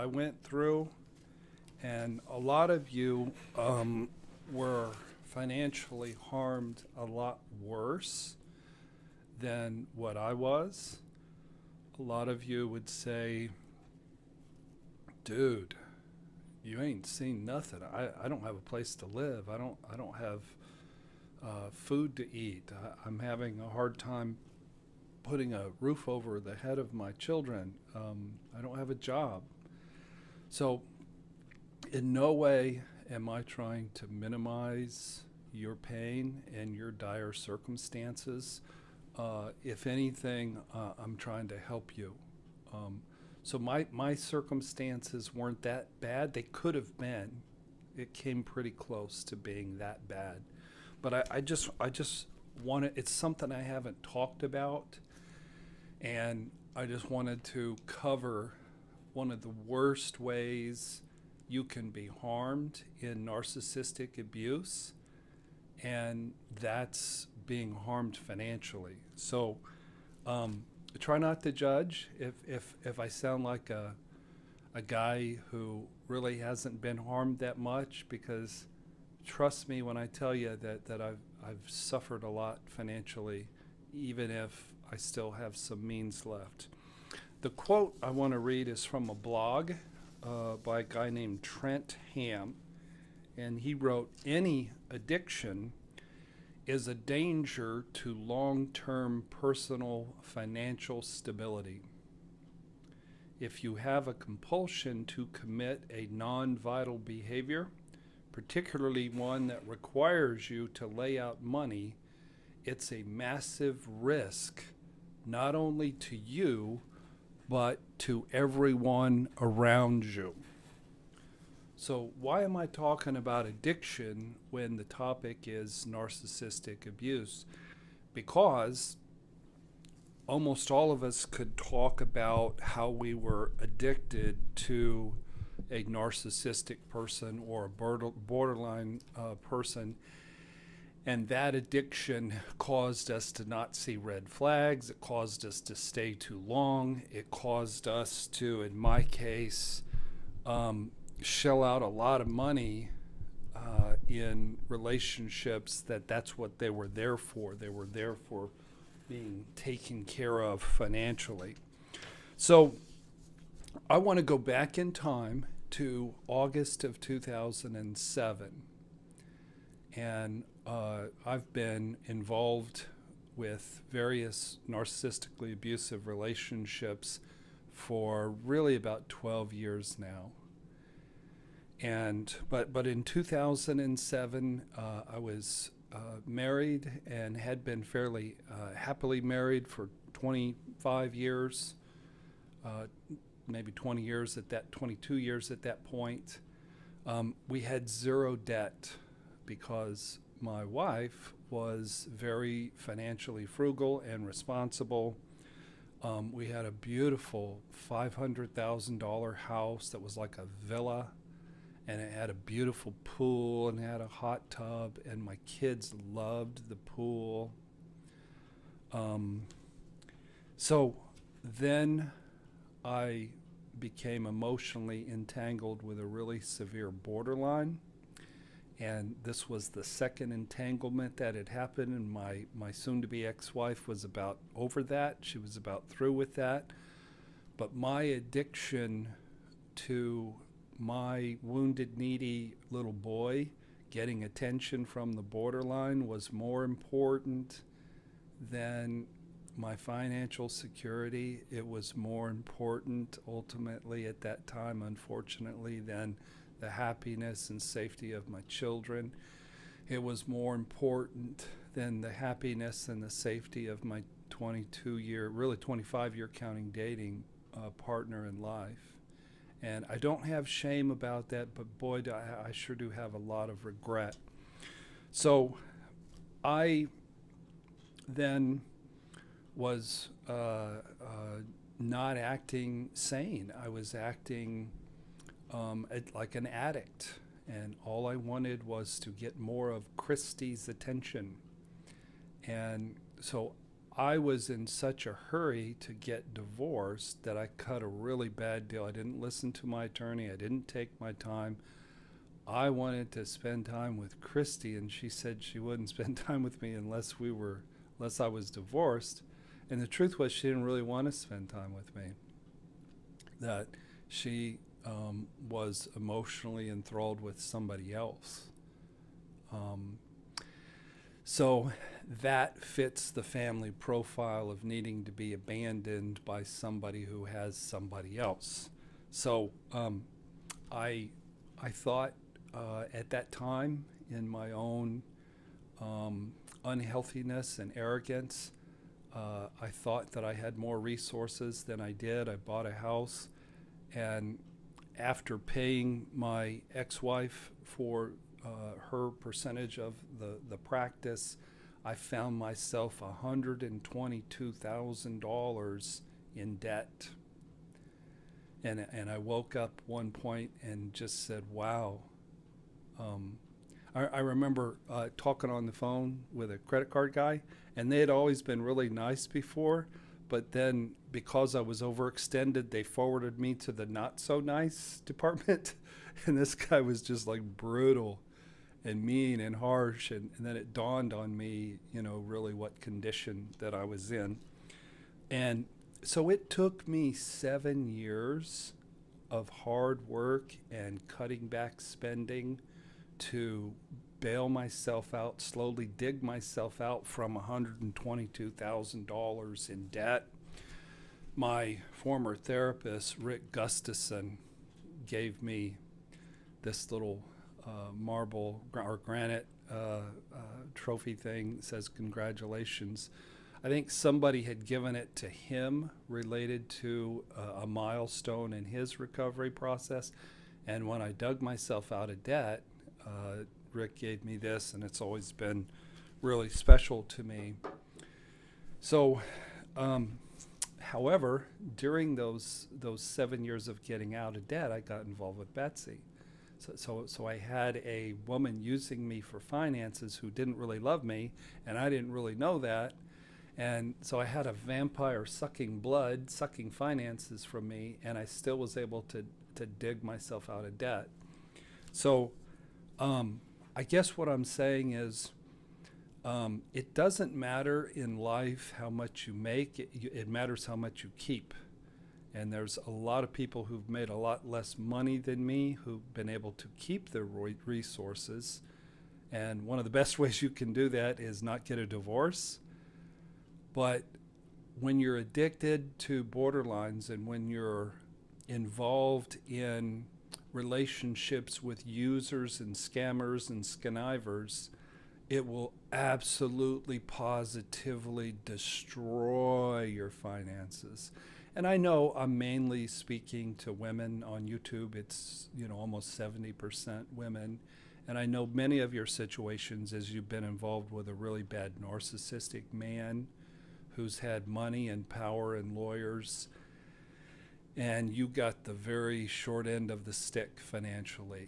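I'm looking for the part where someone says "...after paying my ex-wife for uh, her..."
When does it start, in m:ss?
5:44.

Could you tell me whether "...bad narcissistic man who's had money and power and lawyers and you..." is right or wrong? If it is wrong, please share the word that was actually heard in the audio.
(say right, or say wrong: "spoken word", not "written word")
right.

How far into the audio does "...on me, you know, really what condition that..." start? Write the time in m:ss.
6:21.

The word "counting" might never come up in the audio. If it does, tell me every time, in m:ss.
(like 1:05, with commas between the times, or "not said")
4:26.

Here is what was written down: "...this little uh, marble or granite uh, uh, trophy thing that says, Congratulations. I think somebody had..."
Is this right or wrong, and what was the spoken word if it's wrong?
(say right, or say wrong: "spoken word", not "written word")
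right.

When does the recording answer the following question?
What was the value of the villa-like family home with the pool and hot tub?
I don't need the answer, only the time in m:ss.
3:27.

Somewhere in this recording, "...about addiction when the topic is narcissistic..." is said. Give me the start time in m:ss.
2:03.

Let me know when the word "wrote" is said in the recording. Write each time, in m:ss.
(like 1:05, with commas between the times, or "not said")
1:33.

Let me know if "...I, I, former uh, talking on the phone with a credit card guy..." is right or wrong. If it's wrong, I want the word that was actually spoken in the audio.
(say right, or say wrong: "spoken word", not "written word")
wrong: "remember", not "former".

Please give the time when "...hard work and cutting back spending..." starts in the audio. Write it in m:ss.
6:29.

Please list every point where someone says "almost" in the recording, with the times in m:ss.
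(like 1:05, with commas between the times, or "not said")
2:10, 8:15.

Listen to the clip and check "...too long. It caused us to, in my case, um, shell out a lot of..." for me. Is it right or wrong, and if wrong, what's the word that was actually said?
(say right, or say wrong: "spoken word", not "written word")
right.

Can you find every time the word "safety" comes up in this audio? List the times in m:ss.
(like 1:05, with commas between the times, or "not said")
4:17, 4:23.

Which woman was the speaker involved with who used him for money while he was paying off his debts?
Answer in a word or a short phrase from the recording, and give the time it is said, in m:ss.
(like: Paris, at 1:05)
Betsy, at 7:15.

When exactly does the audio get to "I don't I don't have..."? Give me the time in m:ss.
0:19.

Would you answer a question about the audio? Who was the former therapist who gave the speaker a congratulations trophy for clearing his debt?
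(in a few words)
Rick Gustafson.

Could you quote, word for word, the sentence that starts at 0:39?
Uh, if anything, uh, I'm trying to help you.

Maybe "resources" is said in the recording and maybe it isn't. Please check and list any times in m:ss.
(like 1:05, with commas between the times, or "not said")
5:40, 7:47.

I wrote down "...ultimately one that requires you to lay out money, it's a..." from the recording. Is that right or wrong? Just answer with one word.
wrong.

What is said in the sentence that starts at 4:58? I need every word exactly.
I didn't listen to my attorney, I didn't take my time.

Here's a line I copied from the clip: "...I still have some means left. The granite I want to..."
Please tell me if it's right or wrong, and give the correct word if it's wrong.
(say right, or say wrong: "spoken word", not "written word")
wrong: "quote", not "granite".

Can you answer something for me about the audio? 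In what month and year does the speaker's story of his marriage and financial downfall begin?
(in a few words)
August 2007.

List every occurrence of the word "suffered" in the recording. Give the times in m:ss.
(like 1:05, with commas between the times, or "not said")
1:21.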